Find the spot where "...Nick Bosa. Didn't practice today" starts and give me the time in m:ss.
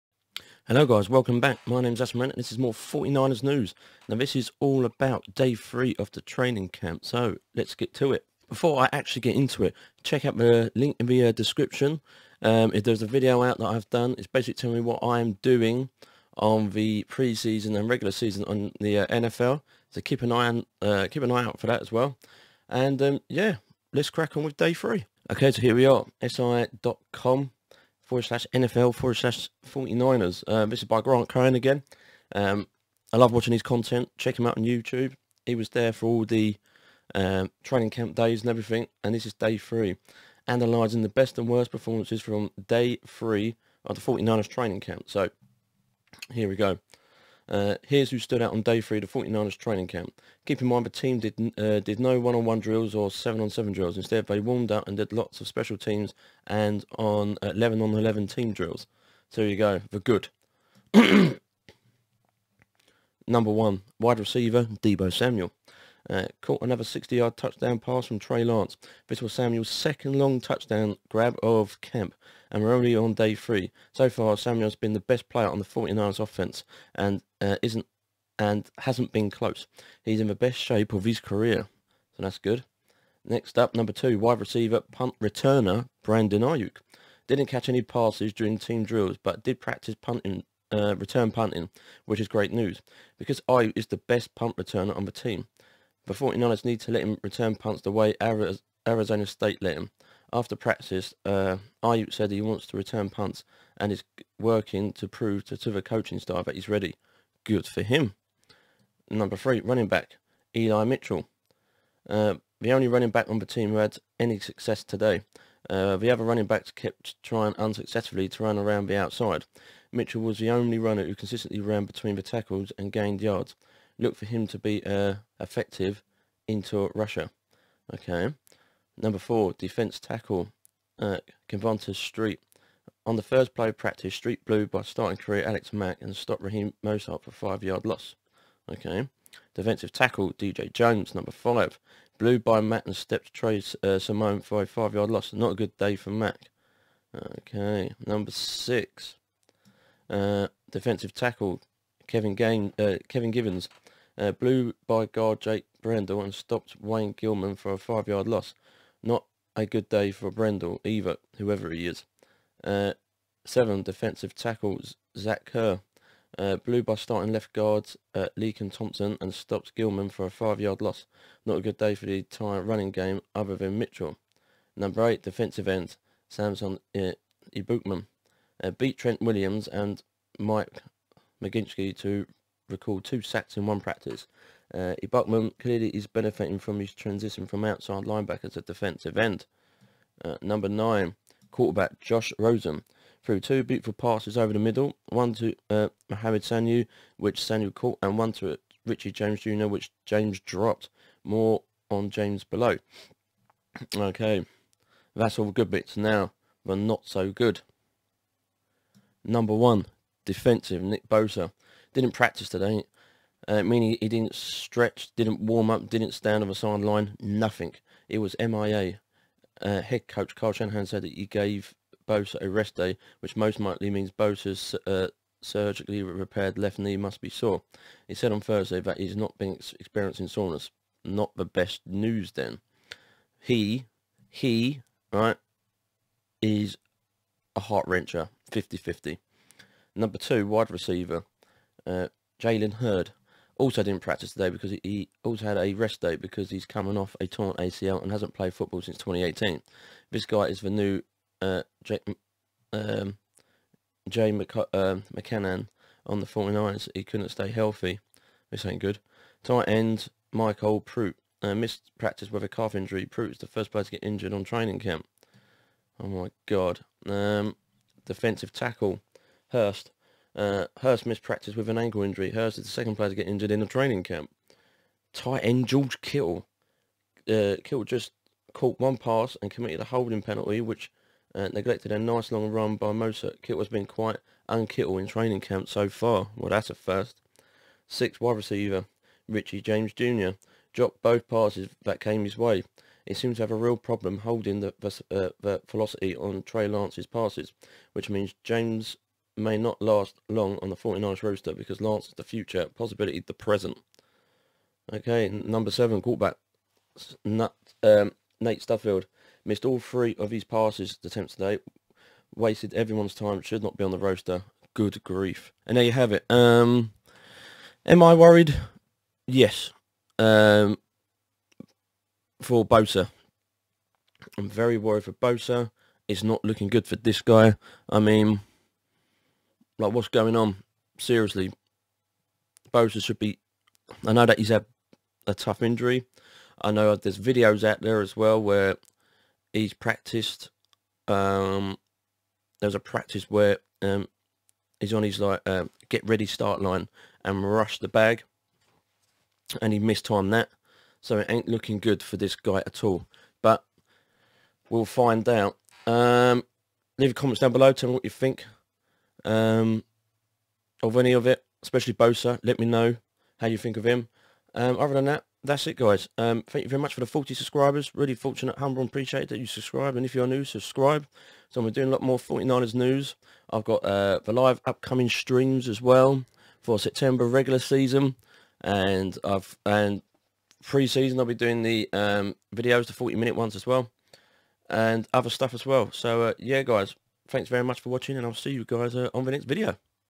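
3:30.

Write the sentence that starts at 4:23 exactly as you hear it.
Prout's the first player to get injured on training camp.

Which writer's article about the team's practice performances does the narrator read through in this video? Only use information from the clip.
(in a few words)
Grant Cohn.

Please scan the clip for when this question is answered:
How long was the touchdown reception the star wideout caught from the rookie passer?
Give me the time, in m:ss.
1:06.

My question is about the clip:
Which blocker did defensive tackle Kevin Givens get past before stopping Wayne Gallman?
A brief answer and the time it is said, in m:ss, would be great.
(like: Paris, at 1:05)
Jake Brendel, at 2:35.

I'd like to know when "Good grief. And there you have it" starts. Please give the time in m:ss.
5:14.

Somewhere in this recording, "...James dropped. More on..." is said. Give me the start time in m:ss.
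3:20.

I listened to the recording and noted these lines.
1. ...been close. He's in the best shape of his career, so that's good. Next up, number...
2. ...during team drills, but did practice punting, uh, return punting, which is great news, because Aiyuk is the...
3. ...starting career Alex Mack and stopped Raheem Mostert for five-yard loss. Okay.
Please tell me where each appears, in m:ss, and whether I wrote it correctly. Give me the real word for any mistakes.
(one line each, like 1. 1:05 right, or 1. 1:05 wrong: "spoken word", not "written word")
1. 1:19 right
2. 1:28 right
3. 2:14 right.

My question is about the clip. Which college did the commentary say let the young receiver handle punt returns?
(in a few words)
Arizona State.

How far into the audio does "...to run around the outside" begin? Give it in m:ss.
1:58.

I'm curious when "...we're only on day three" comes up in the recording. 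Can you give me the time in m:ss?
1:12.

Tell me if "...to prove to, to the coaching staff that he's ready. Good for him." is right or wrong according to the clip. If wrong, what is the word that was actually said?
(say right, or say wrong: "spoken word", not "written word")
right.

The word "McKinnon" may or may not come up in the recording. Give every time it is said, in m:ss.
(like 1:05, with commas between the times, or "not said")
4:15.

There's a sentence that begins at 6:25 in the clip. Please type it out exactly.
So uh, yeah, guys, thanks very much for watching and I'll see you guys uh, on the next video.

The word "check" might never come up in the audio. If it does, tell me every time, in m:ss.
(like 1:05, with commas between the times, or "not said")
0:10, 0:34.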